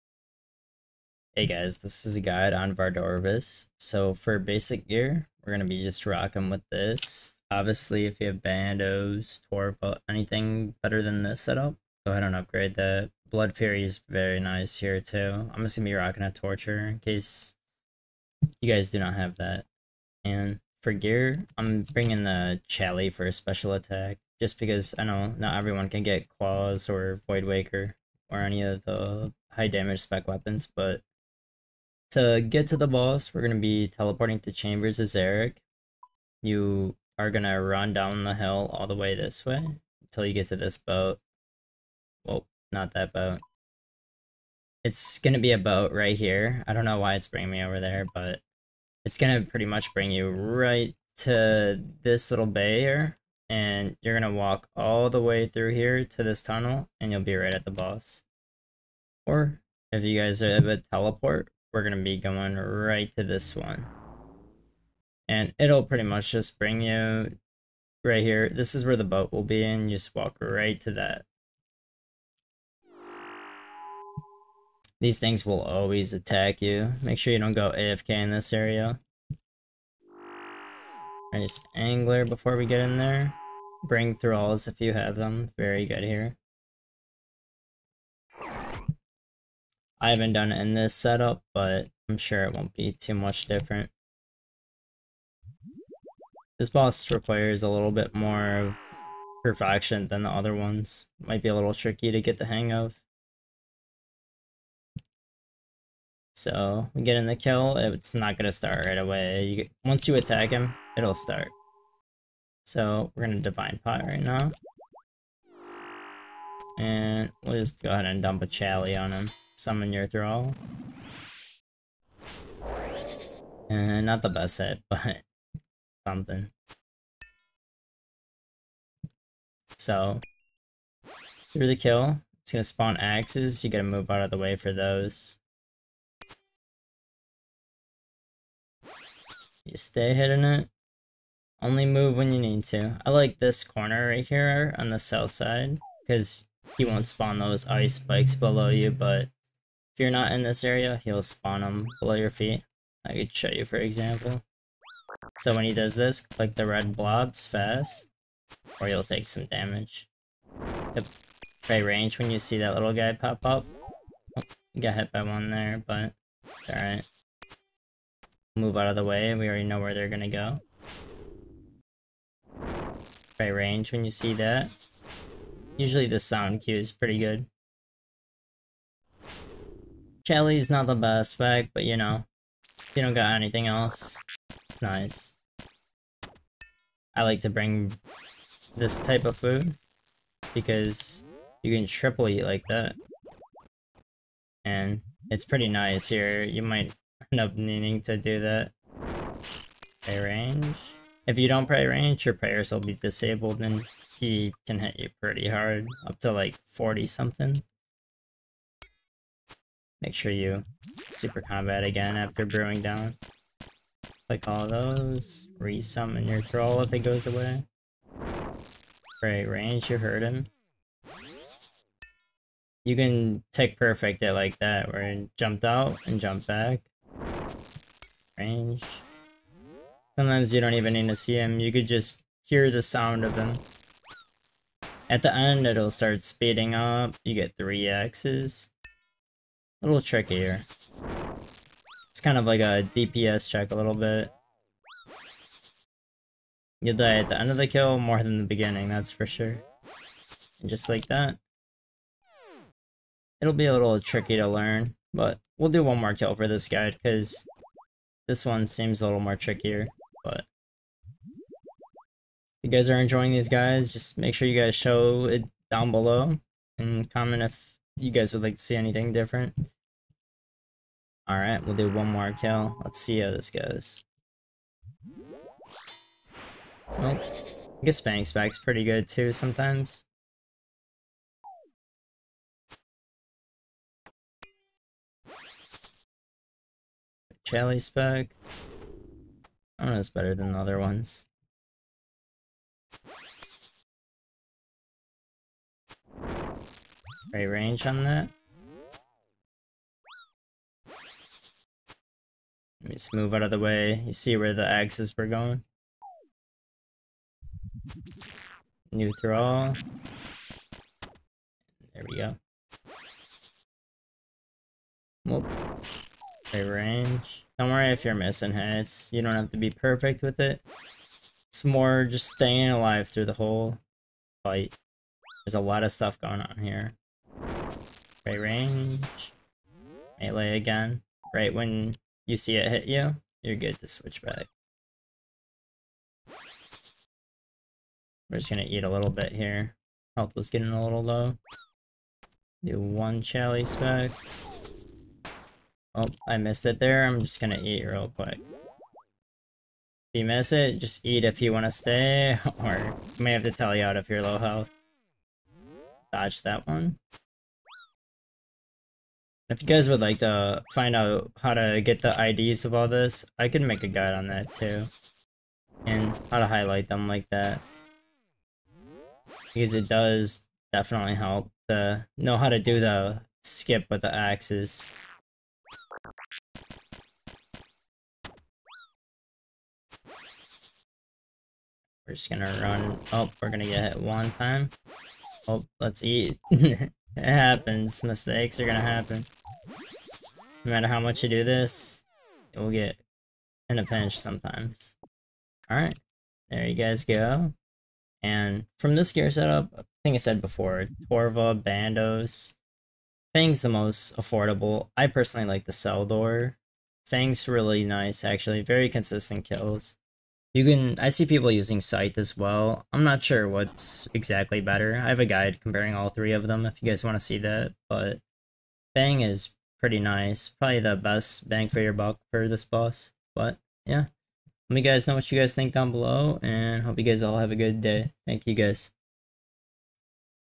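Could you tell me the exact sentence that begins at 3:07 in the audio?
I like to bring this type of food because you can triple eat like that.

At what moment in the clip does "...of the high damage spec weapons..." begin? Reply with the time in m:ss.
0:28.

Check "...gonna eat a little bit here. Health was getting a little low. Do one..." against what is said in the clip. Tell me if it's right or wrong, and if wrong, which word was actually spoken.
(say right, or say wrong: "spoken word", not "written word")
right.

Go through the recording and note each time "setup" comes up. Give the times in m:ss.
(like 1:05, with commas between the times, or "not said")
0:11, 1:30, 6:39.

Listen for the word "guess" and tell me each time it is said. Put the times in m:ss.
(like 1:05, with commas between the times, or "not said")
4:37.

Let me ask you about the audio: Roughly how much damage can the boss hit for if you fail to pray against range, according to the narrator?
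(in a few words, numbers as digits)
40 something.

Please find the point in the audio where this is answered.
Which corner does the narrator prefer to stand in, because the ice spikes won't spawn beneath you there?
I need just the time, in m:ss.
2:24.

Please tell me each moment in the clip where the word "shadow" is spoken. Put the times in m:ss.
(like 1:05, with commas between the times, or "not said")
not said.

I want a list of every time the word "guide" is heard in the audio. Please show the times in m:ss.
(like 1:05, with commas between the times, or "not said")
0:02, 4:16, 6:03, 6:55.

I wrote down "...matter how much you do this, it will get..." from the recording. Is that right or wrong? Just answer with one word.
right.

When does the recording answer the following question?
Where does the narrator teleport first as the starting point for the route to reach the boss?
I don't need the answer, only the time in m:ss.
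0:34.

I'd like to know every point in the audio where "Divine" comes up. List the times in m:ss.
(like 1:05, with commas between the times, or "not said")
1:53.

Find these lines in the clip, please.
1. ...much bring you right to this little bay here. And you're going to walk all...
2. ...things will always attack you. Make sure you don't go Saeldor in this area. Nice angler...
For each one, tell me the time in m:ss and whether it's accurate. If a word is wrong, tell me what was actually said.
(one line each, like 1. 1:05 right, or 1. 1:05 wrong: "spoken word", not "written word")
1. 0:49 right
2. 1:15 wrong: "AFK", not "Saeldor".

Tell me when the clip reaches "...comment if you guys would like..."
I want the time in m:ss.
4:27.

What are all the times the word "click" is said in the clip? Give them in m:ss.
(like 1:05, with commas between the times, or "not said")
2:36, 3:34.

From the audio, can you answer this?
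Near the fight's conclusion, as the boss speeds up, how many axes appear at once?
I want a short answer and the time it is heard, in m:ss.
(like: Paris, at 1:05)
3, at 3:57.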